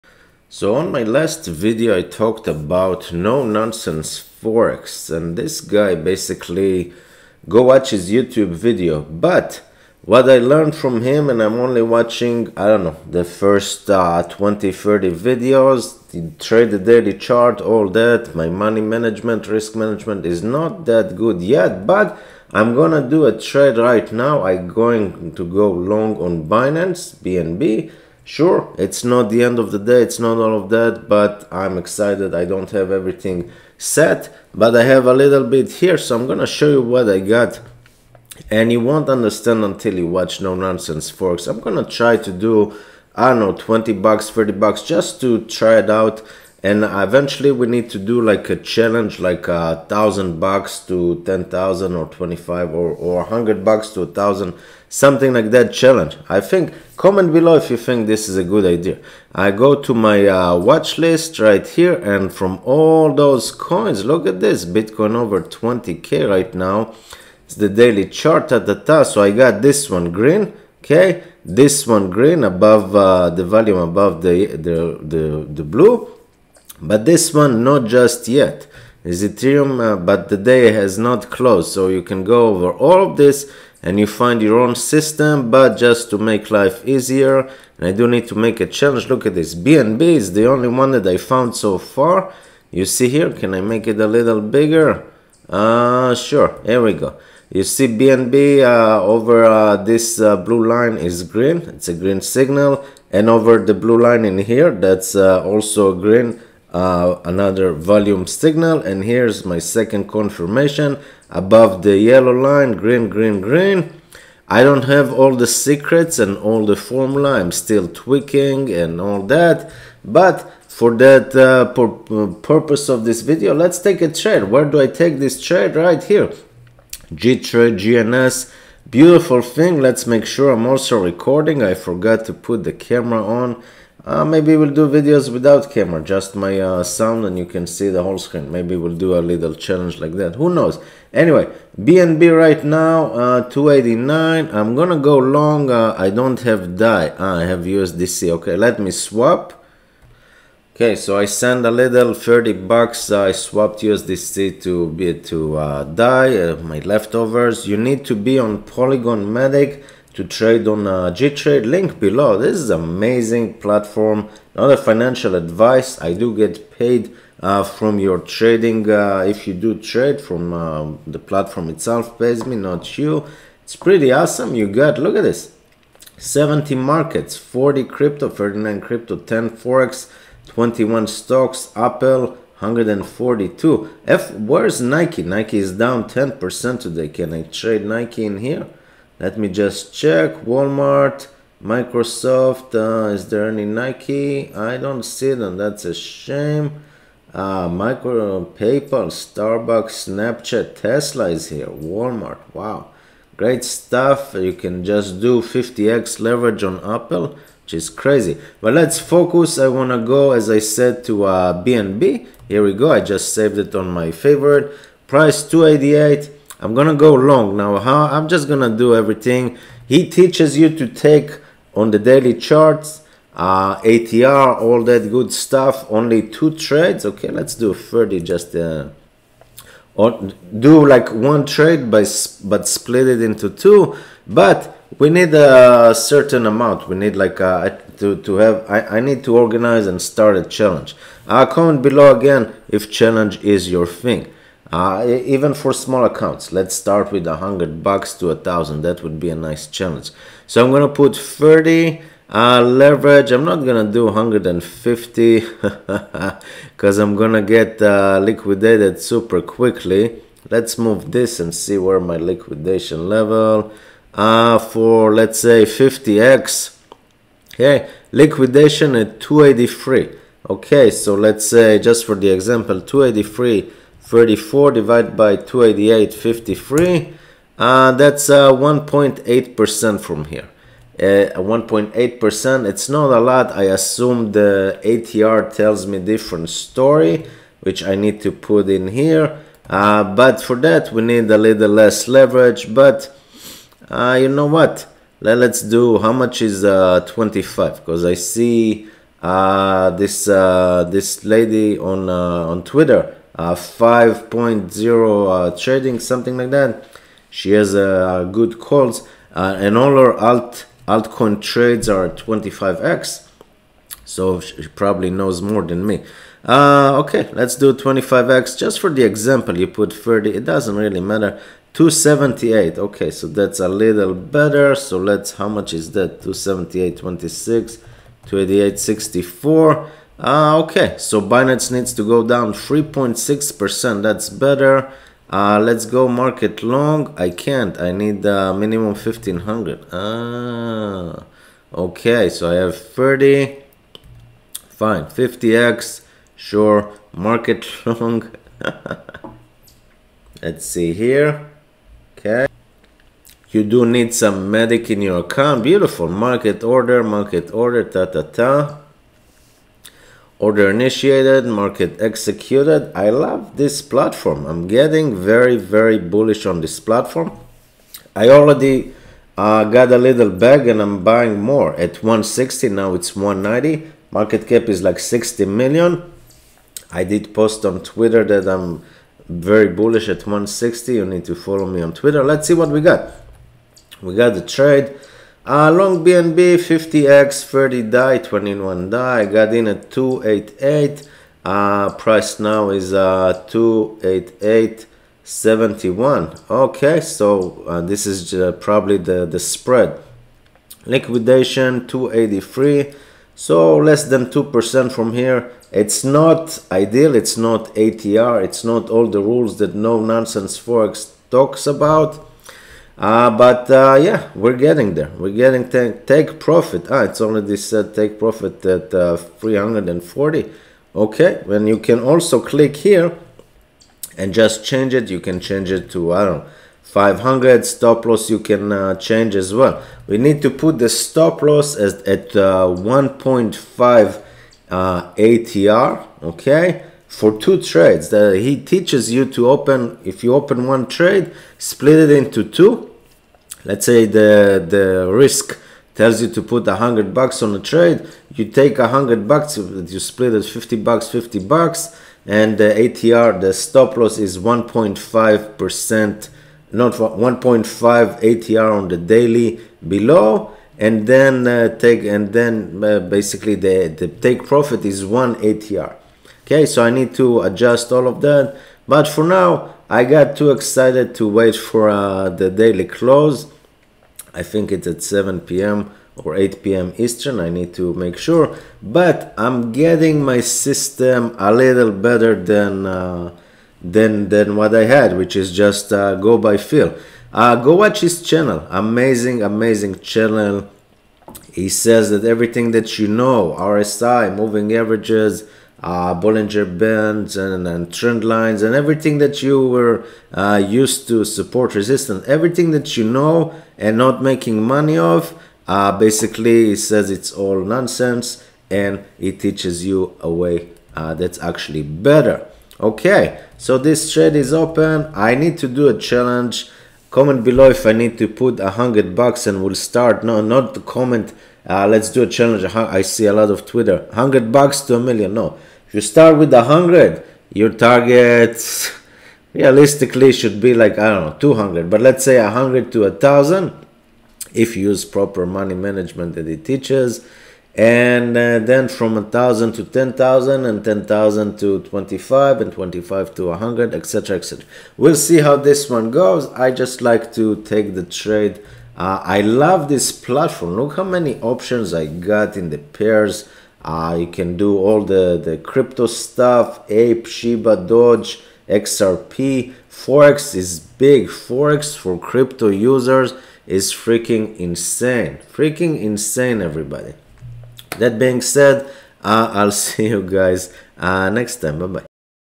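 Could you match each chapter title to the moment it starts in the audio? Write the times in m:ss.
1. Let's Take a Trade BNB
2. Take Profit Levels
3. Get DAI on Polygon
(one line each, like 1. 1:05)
1. 4:10
2. 6:55
3. 2:30.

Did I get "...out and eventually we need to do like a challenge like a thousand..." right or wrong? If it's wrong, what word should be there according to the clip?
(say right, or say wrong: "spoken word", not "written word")
right.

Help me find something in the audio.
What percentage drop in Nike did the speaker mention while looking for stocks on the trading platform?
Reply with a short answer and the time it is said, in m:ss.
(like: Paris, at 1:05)
10%, at 3:05.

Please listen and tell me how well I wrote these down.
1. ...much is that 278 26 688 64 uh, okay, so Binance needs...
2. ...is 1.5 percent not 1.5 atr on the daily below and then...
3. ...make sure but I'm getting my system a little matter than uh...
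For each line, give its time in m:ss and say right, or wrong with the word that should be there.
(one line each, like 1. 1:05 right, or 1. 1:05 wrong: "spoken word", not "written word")
1. 5:25 wrong: "288", not "688"
2. 7:34 right
3. 7:57 wrong: "better", not "matter".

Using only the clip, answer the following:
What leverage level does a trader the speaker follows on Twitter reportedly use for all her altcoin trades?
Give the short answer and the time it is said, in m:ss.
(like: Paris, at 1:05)
25x, at 5:09.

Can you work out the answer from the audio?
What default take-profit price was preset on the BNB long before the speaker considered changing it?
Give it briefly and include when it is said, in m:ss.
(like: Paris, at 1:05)
340, at 6:57.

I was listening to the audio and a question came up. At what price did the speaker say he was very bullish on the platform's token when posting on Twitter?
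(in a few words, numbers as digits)
160.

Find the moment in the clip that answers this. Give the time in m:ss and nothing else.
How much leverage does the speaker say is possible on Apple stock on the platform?
3:25.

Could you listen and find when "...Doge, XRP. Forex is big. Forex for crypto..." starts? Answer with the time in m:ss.
9:17.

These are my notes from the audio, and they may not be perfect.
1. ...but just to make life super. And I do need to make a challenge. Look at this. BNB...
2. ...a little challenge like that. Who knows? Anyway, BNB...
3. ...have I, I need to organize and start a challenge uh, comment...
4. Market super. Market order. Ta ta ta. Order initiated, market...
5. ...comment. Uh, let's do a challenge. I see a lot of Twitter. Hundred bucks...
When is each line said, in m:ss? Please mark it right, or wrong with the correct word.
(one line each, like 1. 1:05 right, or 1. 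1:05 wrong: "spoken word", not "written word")
1. 1:25 wrong: "easier", not "super"
2. 2:19 right
3. 3:58 right
4. 5:56 wrong: "order", not "super"
5. 8:40 right.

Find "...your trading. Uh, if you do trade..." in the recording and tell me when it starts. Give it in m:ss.
2:47.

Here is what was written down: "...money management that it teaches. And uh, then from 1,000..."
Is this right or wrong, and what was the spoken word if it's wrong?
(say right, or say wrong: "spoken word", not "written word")
right.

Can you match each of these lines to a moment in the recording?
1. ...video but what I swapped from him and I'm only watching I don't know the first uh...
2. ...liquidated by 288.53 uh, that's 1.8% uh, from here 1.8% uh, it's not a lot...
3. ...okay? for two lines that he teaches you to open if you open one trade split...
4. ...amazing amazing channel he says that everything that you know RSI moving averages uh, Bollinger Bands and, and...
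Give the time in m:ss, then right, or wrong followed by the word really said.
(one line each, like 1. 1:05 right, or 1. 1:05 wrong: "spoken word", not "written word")
1. 0:08 wrong: "learned", not "swapped"
2. 4:34 wrong: "divided", not "liquidated"
3. 7:16 wrong: "trades", not "lines"
4. 8:08 right.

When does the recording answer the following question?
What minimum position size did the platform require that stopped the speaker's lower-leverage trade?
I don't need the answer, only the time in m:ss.
5:38.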